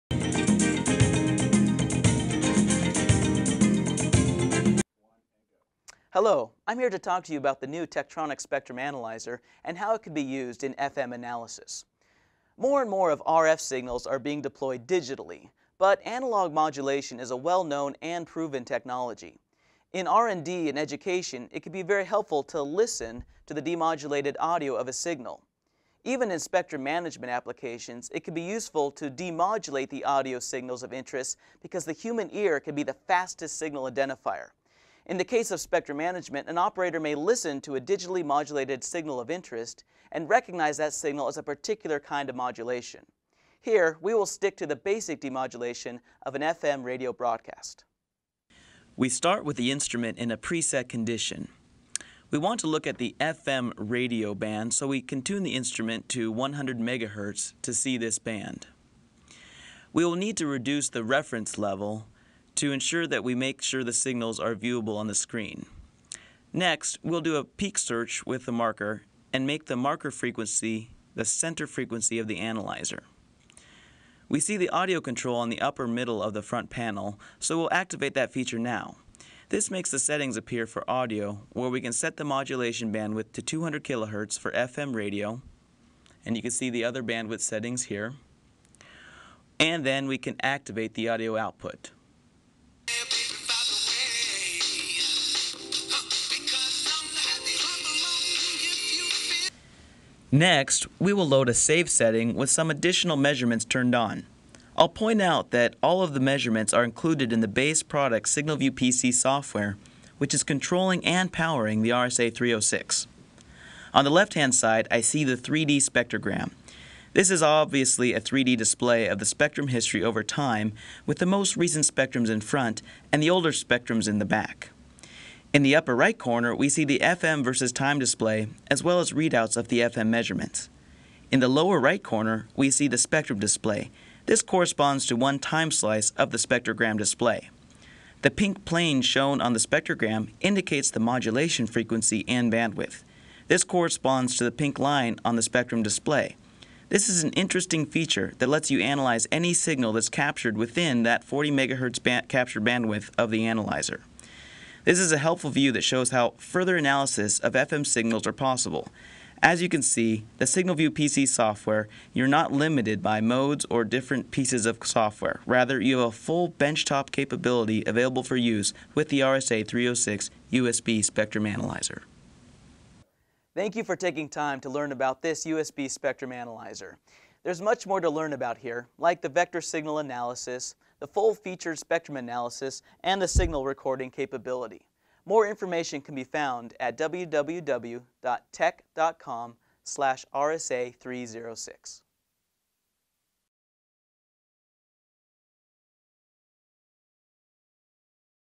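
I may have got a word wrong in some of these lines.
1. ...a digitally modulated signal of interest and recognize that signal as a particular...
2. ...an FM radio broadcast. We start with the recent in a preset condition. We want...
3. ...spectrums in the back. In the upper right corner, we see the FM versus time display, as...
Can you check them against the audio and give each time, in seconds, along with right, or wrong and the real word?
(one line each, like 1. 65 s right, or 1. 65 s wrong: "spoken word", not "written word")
1. 37 s right
2. 46 s wrong: "instrument", not "recent"
3. 123 s right.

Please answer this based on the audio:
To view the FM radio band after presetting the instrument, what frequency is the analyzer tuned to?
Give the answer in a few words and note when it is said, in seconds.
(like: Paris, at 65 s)
100 MHz, at 56 s.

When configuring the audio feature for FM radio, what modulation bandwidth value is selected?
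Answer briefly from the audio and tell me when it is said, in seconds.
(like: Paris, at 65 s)
200 kHz, at 83 s.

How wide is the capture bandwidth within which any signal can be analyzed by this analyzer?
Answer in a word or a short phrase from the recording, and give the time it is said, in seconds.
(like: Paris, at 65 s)
40 MHz, at 151 s.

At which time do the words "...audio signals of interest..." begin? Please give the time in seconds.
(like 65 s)
30 s.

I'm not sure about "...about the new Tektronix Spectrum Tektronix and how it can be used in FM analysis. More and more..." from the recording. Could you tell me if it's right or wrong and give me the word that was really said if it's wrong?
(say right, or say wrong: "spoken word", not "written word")
wrong: "Analyzer", not "Tektronix".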